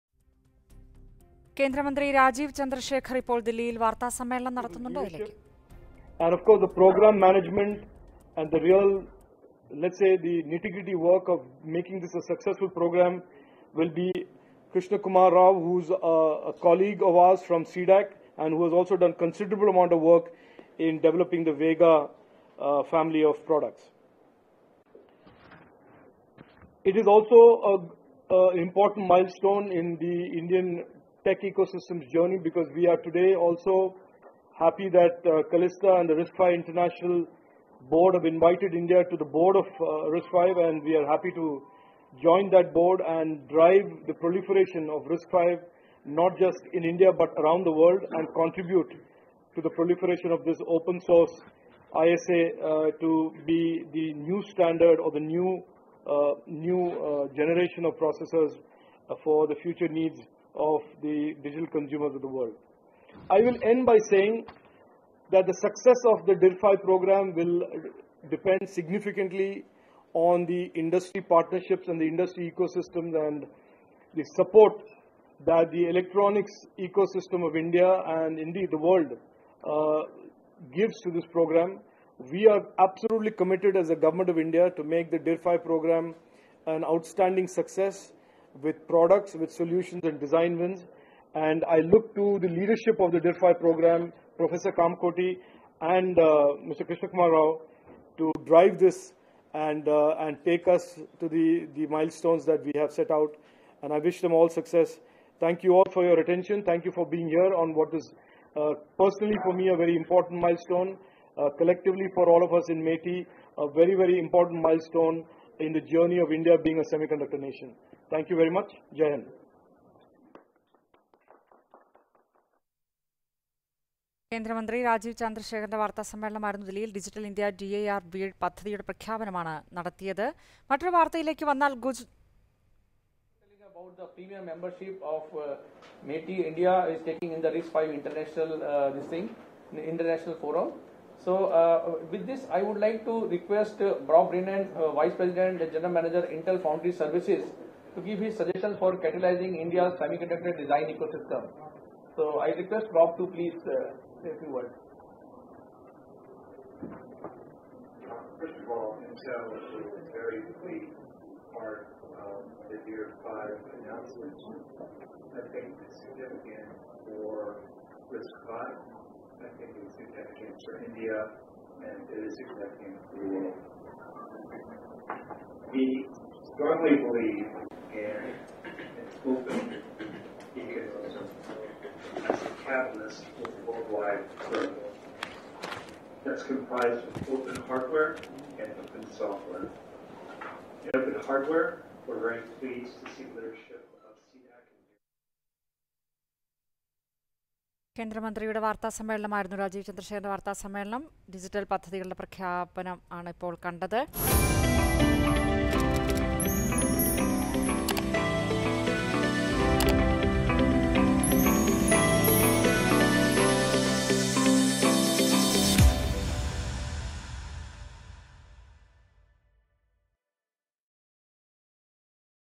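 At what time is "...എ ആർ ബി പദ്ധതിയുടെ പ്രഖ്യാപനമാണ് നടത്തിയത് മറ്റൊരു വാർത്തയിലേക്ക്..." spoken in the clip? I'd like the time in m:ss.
2:07.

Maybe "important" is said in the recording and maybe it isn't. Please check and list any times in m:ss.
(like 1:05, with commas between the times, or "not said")
0:28, 1:49, 1:54.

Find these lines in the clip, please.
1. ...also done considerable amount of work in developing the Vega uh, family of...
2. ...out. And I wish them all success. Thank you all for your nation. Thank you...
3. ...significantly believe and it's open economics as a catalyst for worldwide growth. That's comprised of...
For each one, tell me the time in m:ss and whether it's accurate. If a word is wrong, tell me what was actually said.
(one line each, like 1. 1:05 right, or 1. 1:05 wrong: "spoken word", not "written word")
1. 0:18 right
2. 1:43 wrong: "attention", not "nation"
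3. 2:56 wrong: "strongly", not "significantly".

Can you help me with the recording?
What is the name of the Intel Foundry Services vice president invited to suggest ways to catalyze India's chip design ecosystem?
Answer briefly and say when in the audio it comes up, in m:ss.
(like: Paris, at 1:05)
Bob Brennan, at 2:24.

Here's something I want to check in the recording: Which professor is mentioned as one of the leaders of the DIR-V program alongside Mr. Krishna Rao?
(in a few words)
Professor Kamakoti.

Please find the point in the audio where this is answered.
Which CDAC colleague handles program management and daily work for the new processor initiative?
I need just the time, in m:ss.
0:14.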